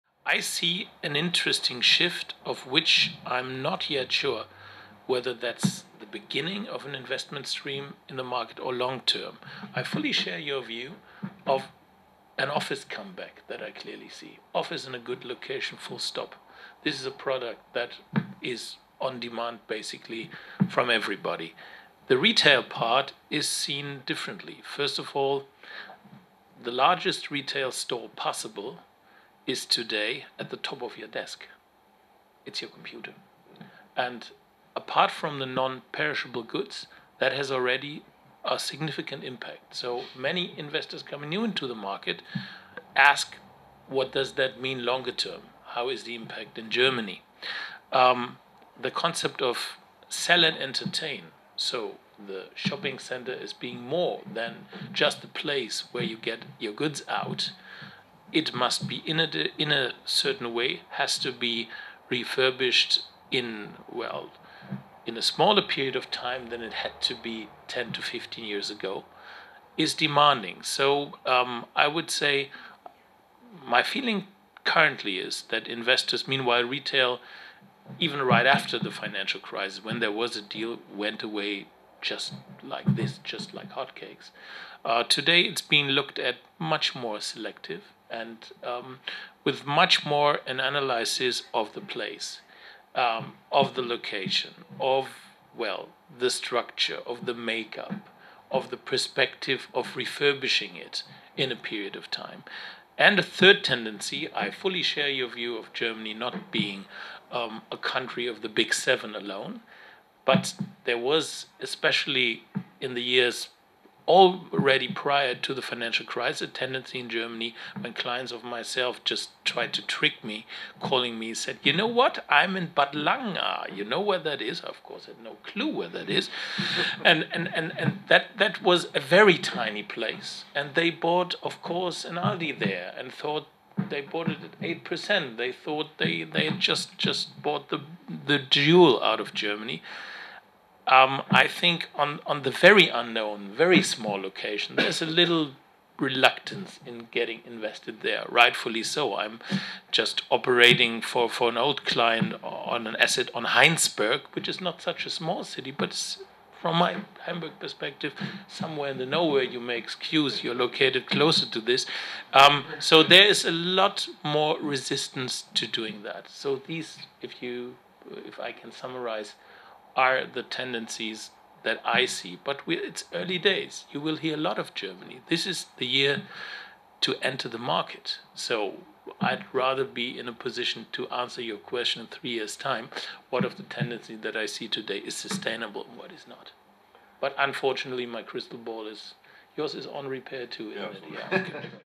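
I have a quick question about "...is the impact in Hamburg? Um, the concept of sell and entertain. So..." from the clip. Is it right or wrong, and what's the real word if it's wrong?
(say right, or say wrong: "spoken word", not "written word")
wrong: "Germany", not "Hamburg".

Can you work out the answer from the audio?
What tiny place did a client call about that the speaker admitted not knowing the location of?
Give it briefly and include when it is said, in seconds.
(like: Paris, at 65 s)
Bad Langa, at 122 s.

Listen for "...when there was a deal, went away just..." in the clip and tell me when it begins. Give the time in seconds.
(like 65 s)
79 s.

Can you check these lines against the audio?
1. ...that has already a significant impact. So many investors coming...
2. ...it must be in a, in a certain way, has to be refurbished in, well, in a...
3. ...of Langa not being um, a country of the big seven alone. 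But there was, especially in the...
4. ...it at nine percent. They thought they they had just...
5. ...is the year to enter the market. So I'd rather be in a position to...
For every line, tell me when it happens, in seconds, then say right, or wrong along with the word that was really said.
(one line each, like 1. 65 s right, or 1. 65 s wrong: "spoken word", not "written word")
1. 37 s right
2. 58 s right
3. 105 s wrong: "Germany", not "Langa"
4. 134 s wrong: "eight", not "nine"
5. 175 s right.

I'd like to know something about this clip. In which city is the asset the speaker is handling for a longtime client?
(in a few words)
Heinsberg.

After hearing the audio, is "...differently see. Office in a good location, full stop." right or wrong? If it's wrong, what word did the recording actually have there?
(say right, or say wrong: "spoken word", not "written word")
wrong: "clearly", not "differently".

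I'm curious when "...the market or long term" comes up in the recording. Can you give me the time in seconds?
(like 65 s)
8 s.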